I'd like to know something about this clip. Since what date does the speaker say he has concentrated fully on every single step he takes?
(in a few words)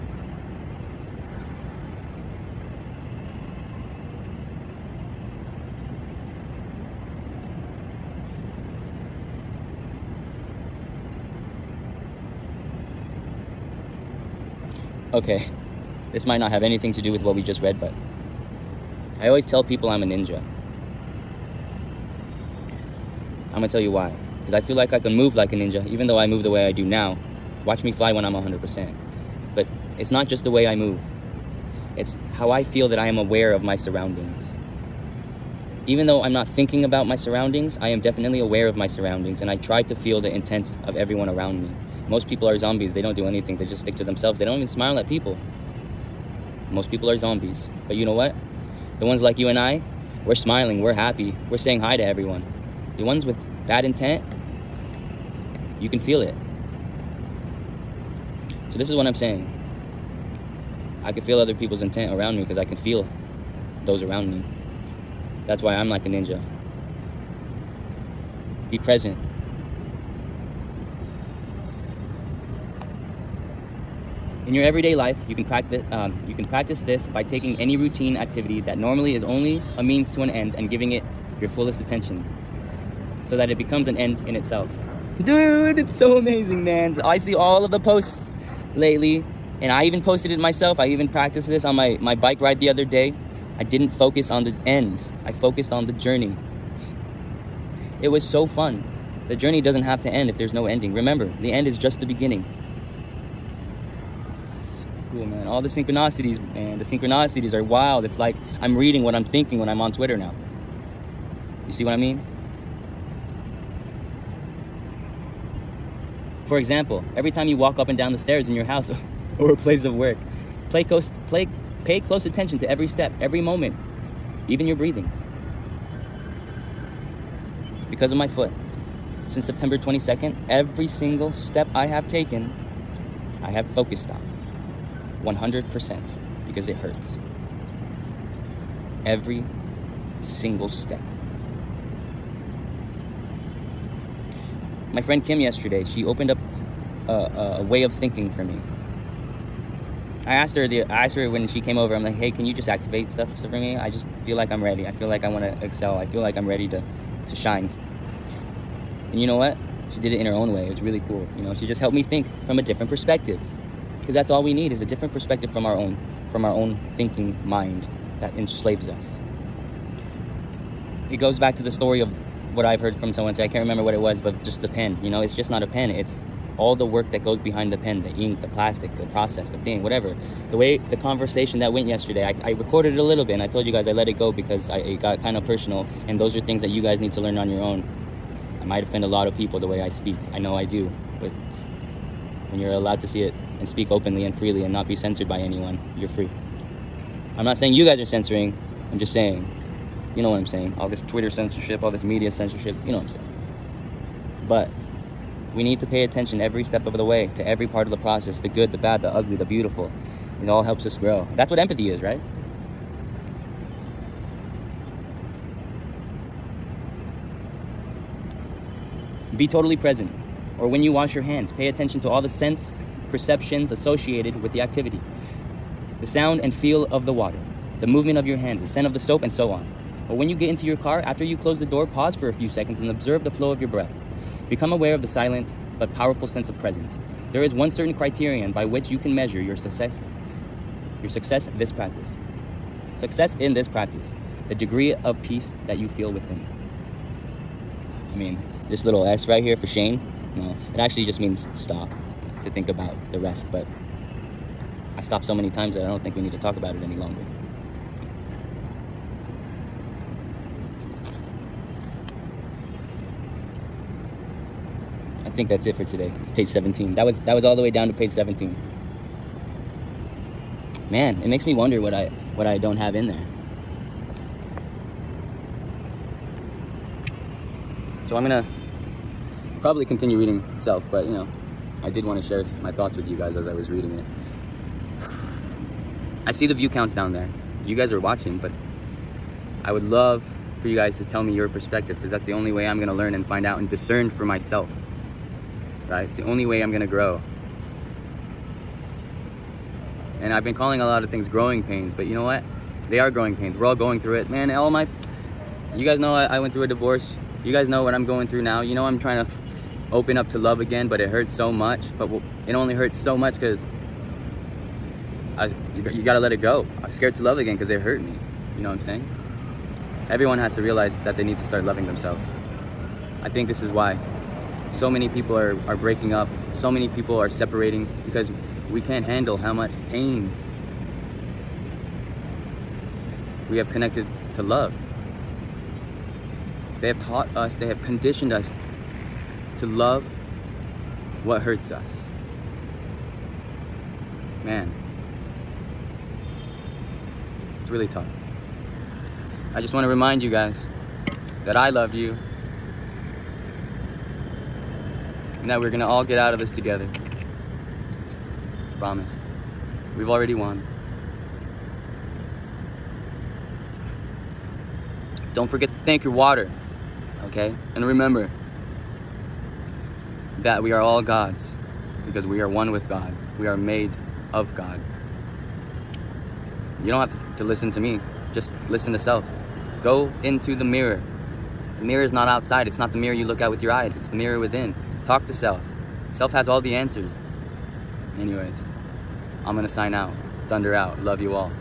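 September 22.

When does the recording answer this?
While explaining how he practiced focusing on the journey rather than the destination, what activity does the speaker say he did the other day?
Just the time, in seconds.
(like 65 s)
92 s.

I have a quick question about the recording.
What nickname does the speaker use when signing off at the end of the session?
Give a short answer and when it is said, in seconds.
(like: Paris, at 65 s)
Thunder, at 390 s.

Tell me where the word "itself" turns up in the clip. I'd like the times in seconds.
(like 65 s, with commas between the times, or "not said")
84 s.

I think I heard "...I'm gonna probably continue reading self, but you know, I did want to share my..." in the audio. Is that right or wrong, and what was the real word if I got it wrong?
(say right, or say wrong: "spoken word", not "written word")
right.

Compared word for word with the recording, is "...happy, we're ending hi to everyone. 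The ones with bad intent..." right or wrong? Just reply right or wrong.
wrong.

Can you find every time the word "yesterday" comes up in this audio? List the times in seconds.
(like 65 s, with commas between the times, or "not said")
145 s, 181 s.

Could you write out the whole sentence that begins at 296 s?
It's the only way I'm going to grow.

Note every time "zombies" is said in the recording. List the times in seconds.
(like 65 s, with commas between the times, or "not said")
42 s, 47 s.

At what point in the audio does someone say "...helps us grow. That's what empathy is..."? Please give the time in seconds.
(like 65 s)
210 s.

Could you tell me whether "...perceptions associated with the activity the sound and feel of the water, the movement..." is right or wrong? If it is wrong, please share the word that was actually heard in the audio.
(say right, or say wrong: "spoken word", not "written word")
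right.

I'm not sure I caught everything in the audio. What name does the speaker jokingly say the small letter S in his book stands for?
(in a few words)
Shane.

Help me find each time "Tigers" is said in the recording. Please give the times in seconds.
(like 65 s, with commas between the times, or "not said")
not said.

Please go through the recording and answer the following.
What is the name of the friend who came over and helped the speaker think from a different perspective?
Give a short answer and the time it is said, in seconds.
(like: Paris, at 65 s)
Kim, at 145 s.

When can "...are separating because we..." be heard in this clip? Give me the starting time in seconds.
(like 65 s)
327 s.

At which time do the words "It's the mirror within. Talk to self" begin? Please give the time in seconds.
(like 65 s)
383 s.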